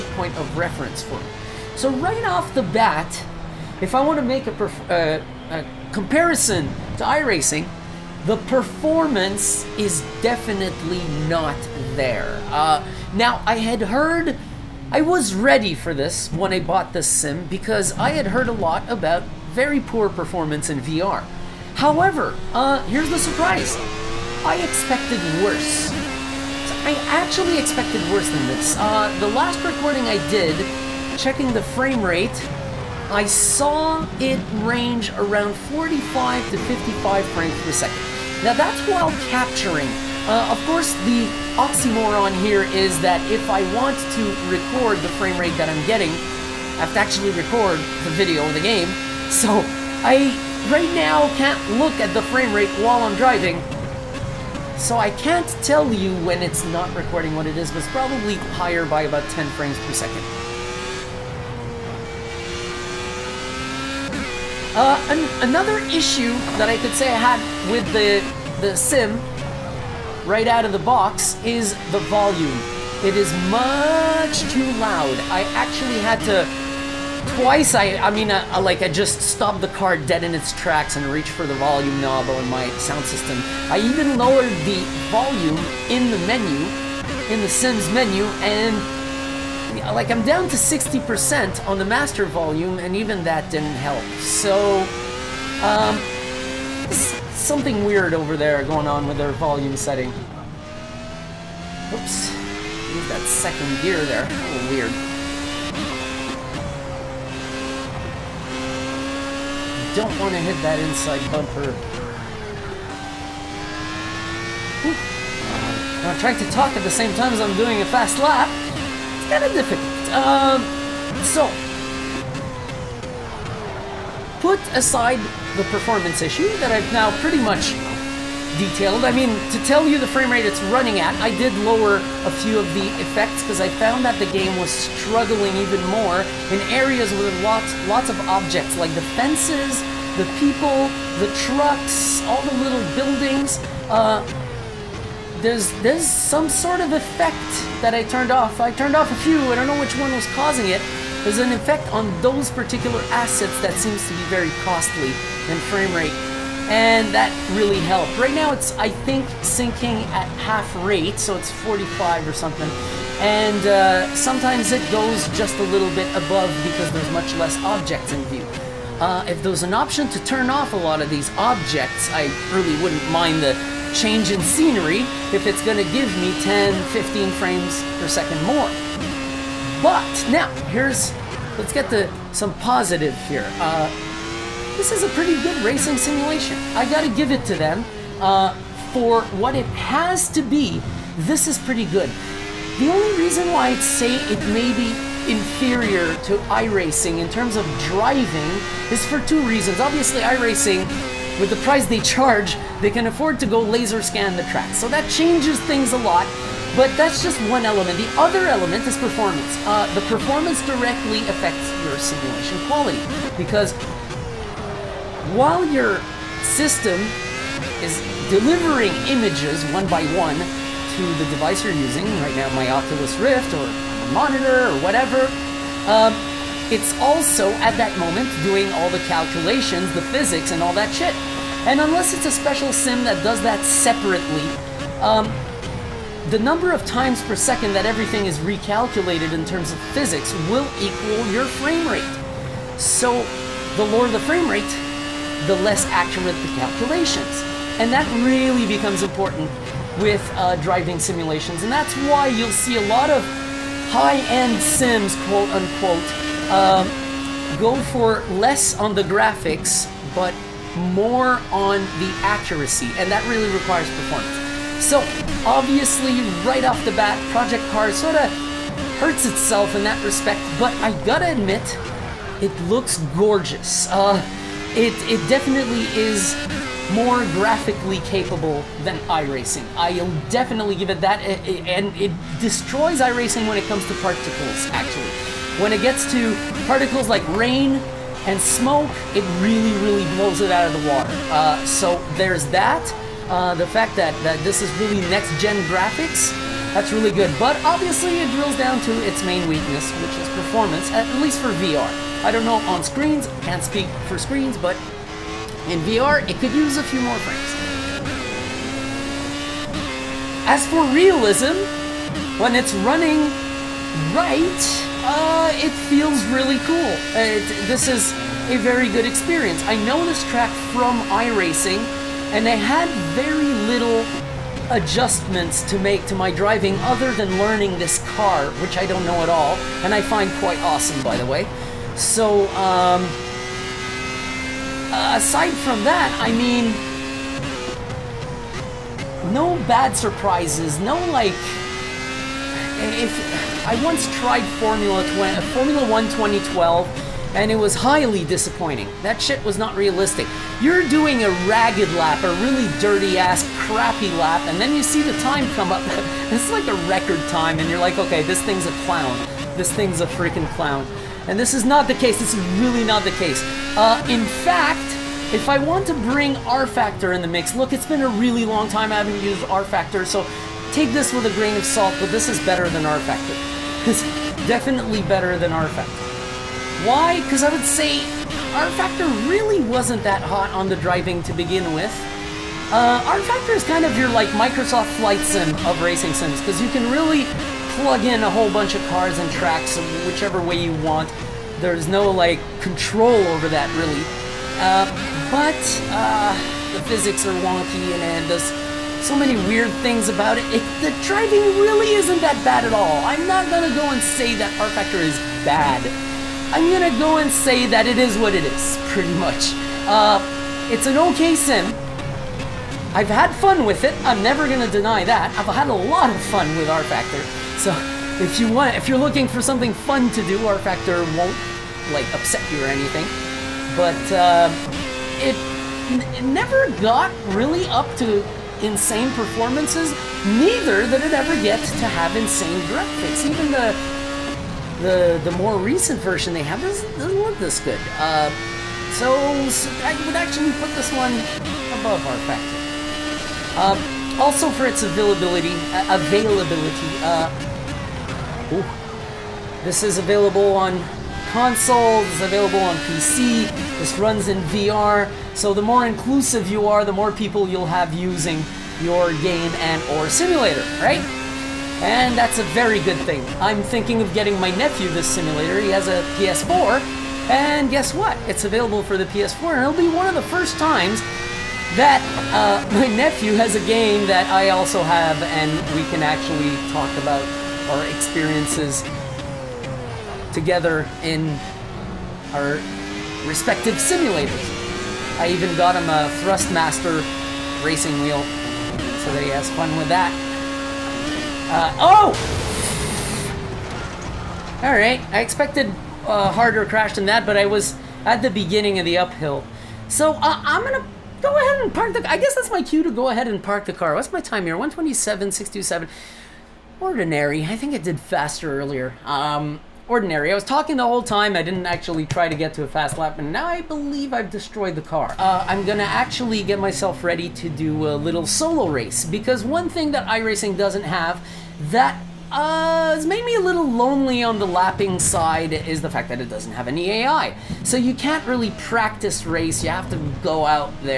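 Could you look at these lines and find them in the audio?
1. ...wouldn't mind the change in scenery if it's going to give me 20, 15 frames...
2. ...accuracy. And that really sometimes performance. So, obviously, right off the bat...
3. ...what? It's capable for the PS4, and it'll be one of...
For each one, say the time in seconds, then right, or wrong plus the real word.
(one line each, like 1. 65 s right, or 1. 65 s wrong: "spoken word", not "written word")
1. 172 s wrong: "10", not "20"
2. 262 s wrong: "requires", not "sometimes"
3. 467 s wrong: "available", not "capable".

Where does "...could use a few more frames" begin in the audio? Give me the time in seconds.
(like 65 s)
306 s.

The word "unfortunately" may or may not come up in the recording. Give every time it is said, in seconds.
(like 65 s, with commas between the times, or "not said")
not said.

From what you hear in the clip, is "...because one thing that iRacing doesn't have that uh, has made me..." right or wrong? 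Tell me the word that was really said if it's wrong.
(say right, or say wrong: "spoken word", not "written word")
right.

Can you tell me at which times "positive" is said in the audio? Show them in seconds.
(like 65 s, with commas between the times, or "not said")
182 s.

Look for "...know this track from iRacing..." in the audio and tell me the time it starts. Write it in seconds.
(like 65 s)
319 s.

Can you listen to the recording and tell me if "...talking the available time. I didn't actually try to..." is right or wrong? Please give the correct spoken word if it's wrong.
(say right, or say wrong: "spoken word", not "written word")
wrong: "whole", not "available".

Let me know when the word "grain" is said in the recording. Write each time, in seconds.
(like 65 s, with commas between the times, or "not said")
371 s.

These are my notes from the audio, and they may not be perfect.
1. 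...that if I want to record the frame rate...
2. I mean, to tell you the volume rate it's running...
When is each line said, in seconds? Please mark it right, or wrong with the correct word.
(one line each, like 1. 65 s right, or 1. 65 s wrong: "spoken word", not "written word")
1. 42 s right
2. 129 s wrong: "frame", not "volume".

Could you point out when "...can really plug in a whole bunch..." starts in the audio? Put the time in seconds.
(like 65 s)
386 s.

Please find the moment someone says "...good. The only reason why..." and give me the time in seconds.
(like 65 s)
191 s.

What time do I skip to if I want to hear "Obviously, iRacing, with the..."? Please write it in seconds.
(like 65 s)
199 s.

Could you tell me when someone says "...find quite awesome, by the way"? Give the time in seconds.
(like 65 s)
330 s.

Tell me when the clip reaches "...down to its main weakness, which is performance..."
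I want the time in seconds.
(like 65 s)
298 s.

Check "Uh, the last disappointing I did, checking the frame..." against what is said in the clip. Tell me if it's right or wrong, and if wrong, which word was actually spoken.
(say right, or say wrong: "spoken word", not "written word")
wrong: "recording", not "disappointing".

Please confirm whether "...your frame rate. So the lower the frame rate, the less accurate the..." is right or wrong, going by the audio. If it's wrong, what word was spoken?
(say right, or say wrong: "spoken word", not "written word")
right.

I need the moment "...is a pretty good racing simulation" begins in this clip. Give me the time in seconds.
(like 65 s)
184 s.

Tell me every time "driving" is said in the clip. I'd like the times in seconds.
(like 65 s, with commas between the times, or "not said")
53 s, 197 s, 250 s, 326 s, 380 s, 401 s.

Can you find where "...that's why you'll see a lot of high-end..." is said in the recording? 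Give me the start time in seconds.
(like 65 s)
251 s.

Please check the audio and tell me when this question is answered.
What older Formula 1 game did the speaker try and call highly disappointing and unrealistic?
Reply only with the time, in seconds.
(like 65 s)
345 s.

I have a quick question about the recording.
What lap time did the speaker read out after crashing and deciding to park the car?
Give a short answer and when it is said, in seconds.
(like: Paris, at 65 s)
1:27.627, at 504 s.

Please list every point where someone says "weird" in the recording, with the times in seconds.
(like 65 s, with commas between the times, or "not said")
97 s, 104 s, 399 s.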